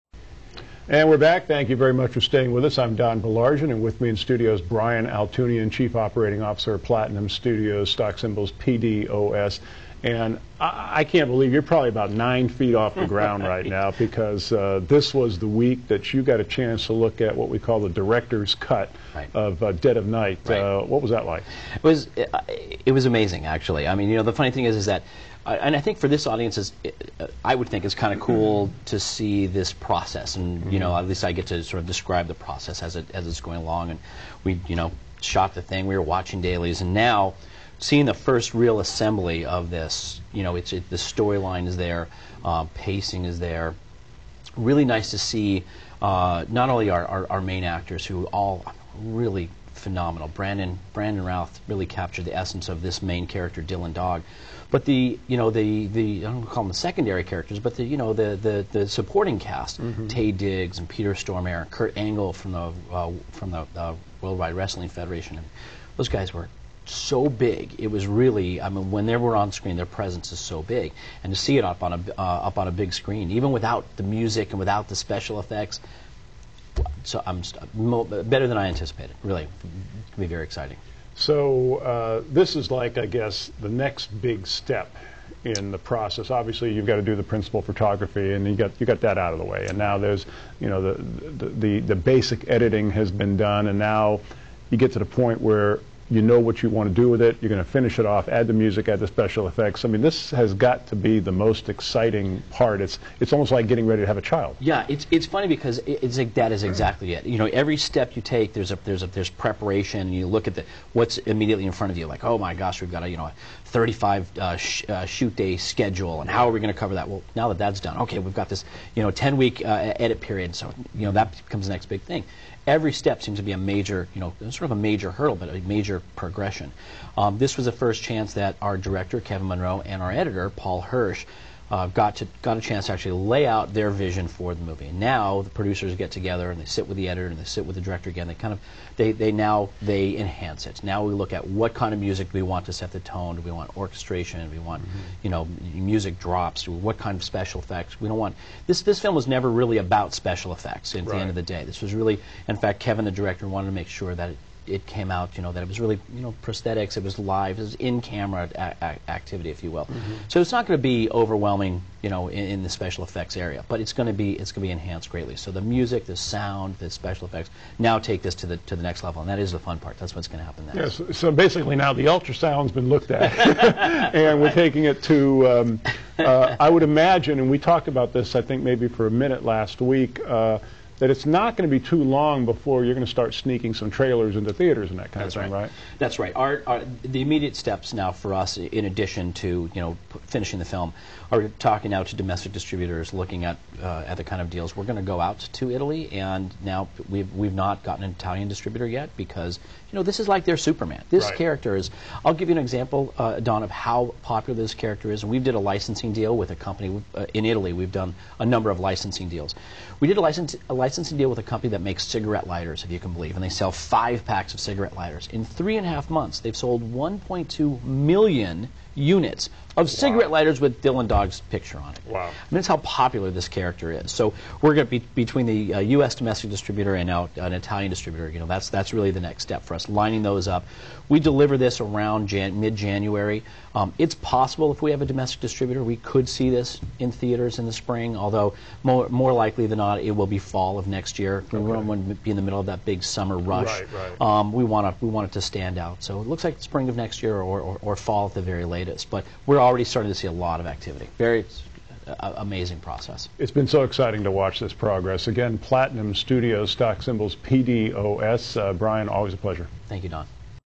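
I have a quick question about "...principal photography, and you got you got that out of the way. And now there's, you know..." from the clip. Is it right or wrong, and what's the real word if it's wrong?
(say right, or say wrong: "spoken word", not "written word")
right.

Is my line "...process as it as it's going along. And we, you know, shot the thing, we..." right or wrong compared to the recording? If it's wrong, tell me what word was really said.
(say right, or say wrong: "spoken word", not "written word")
right.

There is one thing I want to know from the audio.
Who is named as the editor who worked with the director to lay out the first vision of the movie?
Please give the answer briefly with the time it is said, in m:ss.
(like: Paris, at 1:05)
Paul Hirsch, at 2:10.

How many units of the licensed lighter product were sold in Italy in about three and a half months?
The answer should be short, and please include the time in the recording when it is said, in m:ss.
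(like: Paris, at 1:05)
1.2 million, at 3:36.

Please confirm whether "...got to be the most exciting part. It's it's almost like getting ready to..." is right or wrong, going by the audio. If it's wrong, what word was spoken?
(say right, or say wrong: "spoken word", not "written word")
right.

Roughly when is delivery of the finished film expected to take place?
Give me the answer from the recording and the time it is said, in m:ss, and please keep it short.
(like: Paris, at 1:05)
mid-January, at 3:52.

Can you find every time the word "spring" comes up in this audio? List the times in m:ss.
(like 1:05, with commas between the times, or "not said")
3:57, 4:06.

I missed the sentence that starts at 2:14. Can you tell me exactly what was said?
And now the producers get together and they sit with the editor and they sit with the director again.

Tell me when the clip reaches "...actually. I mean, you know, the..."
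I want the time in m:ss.
0:23.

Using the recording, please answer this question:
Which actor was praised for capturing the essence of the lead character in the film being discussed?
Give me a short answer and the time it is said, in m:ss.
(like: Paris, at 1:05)
Brandon Routh, at 0:50.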